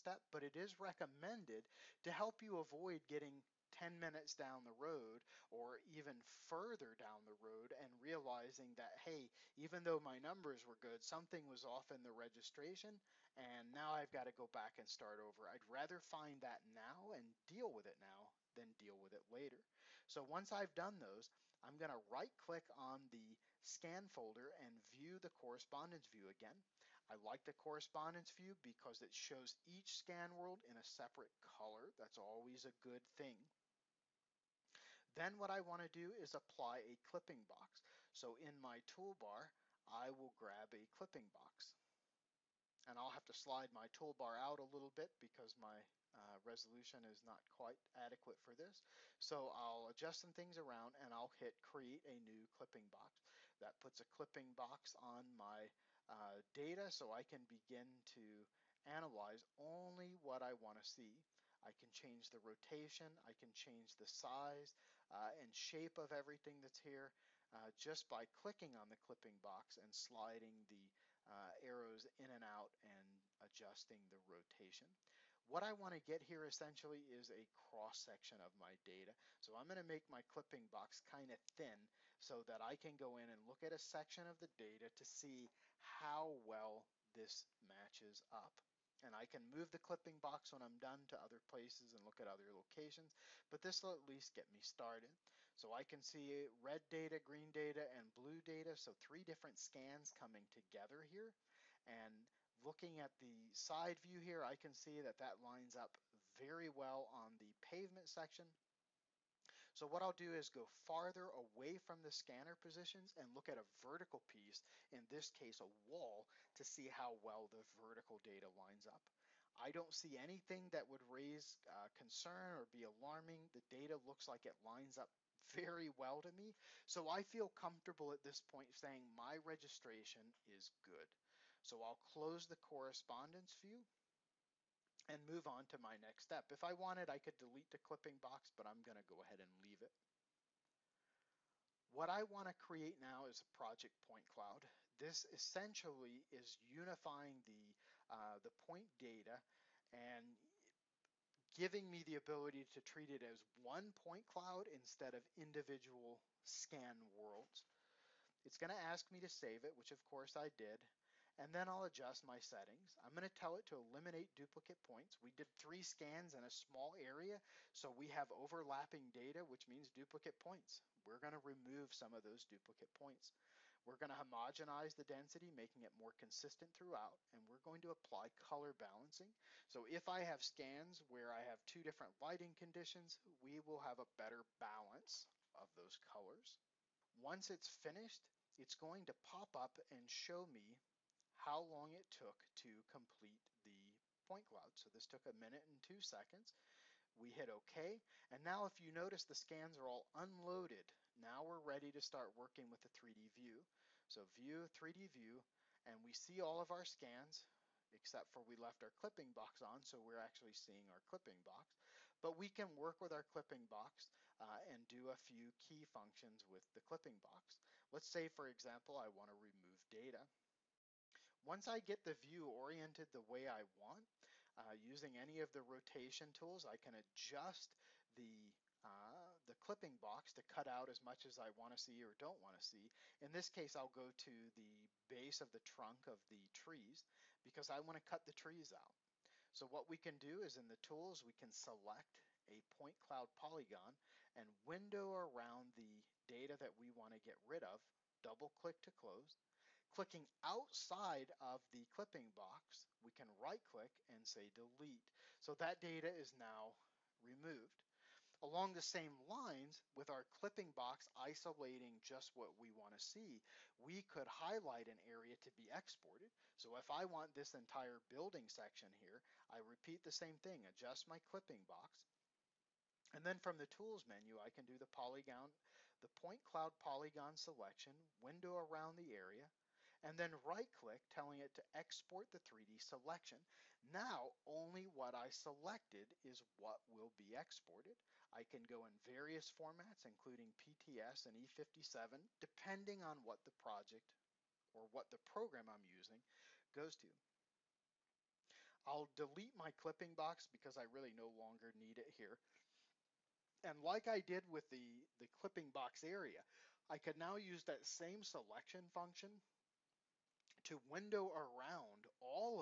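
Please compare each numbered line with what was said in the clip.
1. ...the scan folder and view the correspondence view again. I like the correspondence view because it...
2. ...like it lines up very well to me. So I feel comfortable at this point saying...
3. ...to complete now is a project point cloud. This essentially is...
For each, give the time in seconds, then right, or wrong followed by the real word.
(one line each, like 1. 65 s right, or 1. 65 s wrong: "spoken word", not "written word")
1. 23 s right
2. 124 s right
3. 142 s wrong: "create", not "complete".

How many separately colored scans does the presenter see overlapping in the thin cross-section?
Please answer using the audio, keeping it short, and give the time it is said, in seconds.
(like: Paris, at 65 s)
3, at 98 s.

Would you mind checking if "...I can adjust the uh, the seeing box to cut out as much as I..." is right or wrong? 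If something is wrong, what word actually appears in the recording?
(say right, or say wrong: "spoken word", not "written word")
wrong: "clipping", not "seeing".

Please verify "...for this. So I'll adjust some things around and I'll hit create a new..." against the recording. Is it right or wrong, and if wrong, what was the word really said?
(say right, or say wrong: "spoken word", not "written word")
right.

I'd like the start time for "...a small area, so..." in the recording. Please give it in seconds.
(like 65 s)
166 s.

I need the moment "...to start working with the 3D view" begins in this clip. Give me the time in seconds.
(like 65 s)
201 s.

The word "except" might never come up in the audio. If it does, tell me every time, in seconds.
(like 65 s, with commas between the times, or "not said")
207 s.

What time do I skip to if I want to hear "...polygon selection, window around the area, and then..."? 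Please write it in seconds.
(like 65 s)
276 s.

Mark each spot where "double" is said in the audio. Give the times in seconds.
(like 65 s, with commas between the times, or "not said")
248 s.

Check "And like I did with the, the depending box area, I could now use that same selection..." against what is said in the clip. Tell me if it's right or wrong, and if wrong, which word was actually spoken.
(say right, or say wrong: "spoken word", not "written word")
wrong: "clipping", not "depending".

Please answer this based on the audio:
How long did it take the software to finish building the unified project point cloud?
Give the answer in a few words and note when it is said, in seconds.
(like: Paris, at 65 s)
1 minute 2 seconds, at 195 s.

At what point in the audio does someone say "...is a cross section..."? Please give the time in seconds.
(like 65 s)
77 s.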